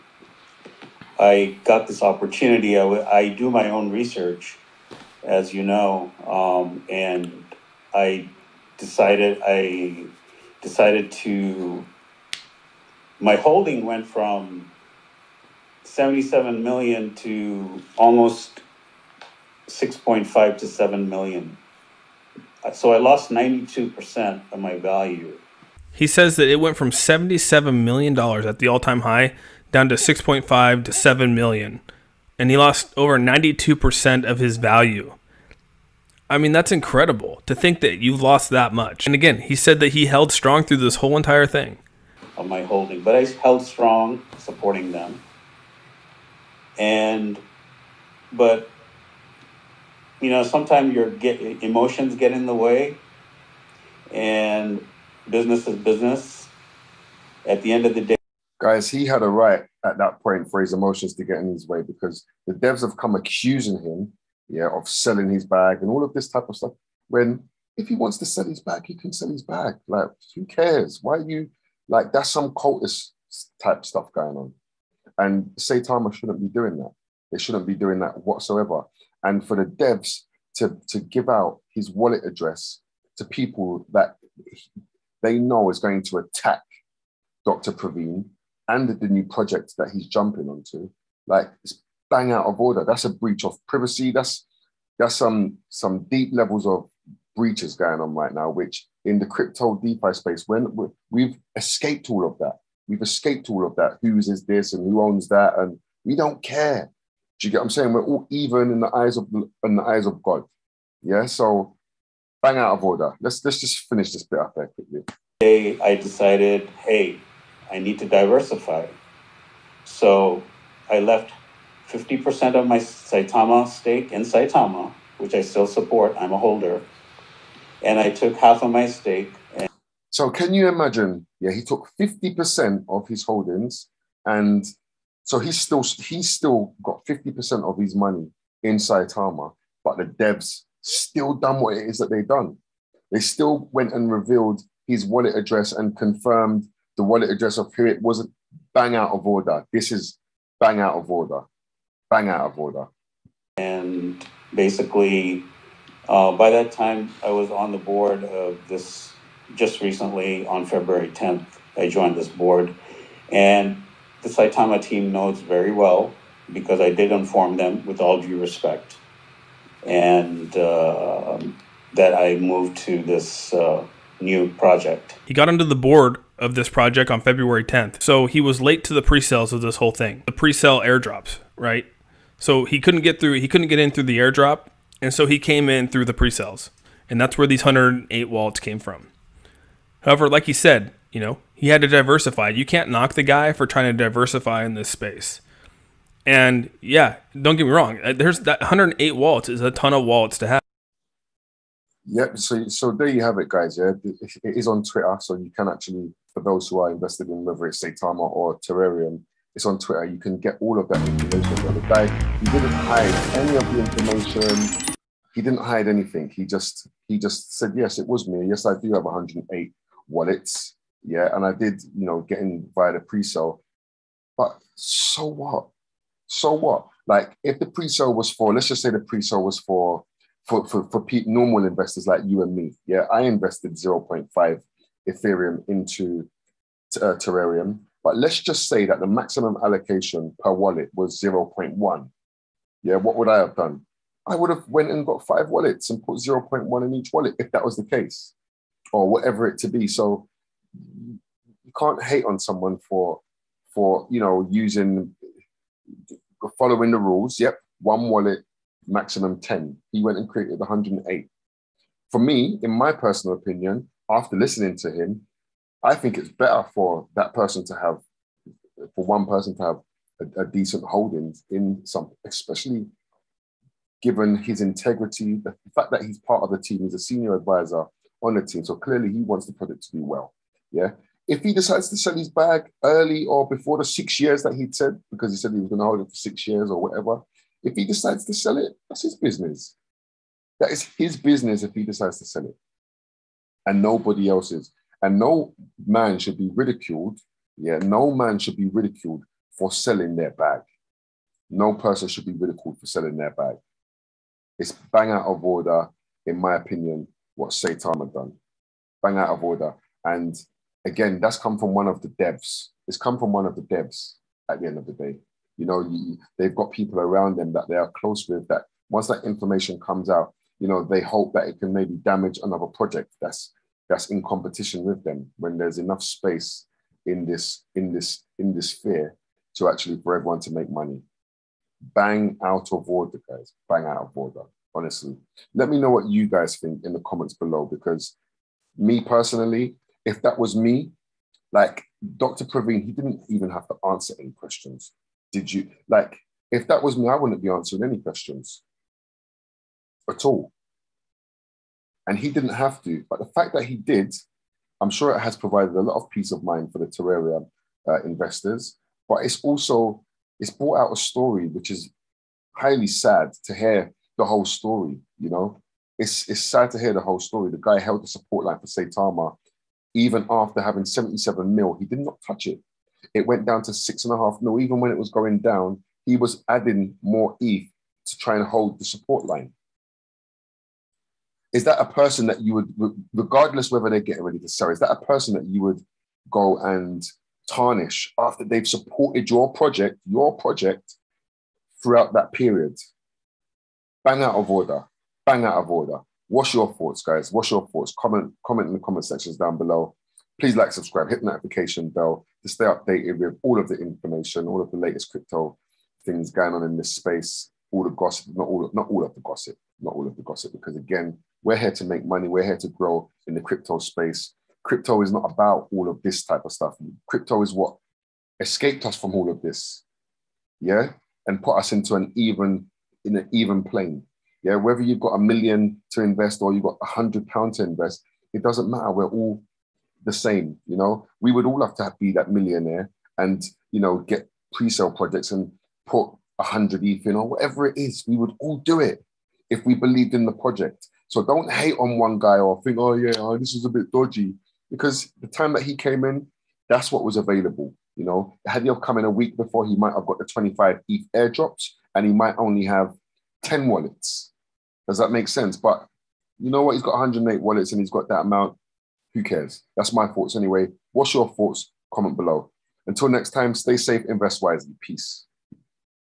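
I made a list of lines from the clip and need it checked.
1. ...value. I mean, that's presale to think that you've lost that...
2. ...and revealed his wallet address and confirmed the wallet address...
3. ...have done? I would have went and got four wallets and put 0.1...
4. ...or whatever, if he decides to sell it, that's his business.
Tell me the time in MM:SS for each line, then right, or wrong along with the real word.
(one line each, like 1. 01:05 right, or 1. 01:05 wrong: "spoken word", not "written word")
1. 00:34 wrong: "incredible", not "presale"
2. 02:23 right
3. 04:03 wrong: "five", not "four"
4. 04:46 right.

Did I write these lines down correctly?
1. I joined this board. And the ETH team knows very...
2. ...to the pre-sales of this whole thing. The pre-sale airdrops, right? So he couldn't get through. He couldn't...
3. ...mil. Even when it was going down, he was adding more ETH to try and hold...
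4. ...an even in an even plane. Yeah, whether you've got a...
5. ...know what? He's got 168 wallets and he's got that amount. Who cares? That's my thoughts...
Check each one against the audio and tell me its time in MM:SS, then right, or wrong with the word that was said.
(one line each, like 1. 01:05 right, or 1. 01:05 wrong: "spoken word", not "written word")
1. 02:41 wrong: "Saitama", not "ETH"
2. 02:58 right
3. 06:14 right
4. 07:01 right
5. 07:36 wrong: "108", not "168".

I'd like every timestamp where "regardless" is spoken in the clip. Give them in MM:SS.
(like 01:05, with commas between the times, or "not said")
06:23.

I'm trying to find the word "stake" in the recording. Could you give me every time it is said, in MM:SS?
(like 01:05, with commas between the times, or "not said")
02:03, 02:08.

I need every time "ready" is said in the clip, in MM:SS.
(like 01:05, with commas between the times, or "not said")
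06:24.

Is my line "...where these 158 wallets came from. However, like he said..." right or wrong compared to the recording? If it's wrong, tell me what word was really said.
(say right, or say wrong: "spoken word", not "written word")
wrong: "108", not "158".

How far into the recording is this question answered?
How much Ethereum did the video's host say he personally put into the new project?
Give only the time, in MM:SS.
03:53.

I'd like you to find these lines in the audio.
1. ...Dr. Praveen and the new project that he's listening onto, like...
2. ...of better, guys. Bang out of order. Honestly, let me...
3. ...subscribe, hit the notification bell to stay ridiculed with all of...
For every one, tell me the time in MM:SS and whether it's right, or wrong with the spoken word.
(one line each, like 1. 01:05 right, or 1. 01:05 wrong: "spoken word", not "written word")
1. 01:27 wrong: "jumping", not "listening"
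2. 05:32 wrong: "order", not "better"
3. 06:40 wrong: "updated", not "ridiculed".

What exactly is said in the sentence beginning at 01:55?
Hey, I decided, hey, I need to diversify.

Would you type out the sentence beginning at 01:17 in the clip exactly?
They shouldn't be doing that whatsoever.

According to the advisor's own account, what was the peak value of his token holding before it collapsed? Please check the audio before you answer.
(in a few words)
77 million.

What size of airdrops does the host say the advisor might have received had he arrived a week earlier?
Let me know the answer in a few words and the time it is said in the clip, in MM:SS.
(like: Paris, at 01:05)
25 ETH, at 07:30.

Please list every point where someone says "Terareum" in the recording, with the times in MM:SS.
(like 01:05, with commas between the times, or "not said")
03:28, 03:57, 05:56.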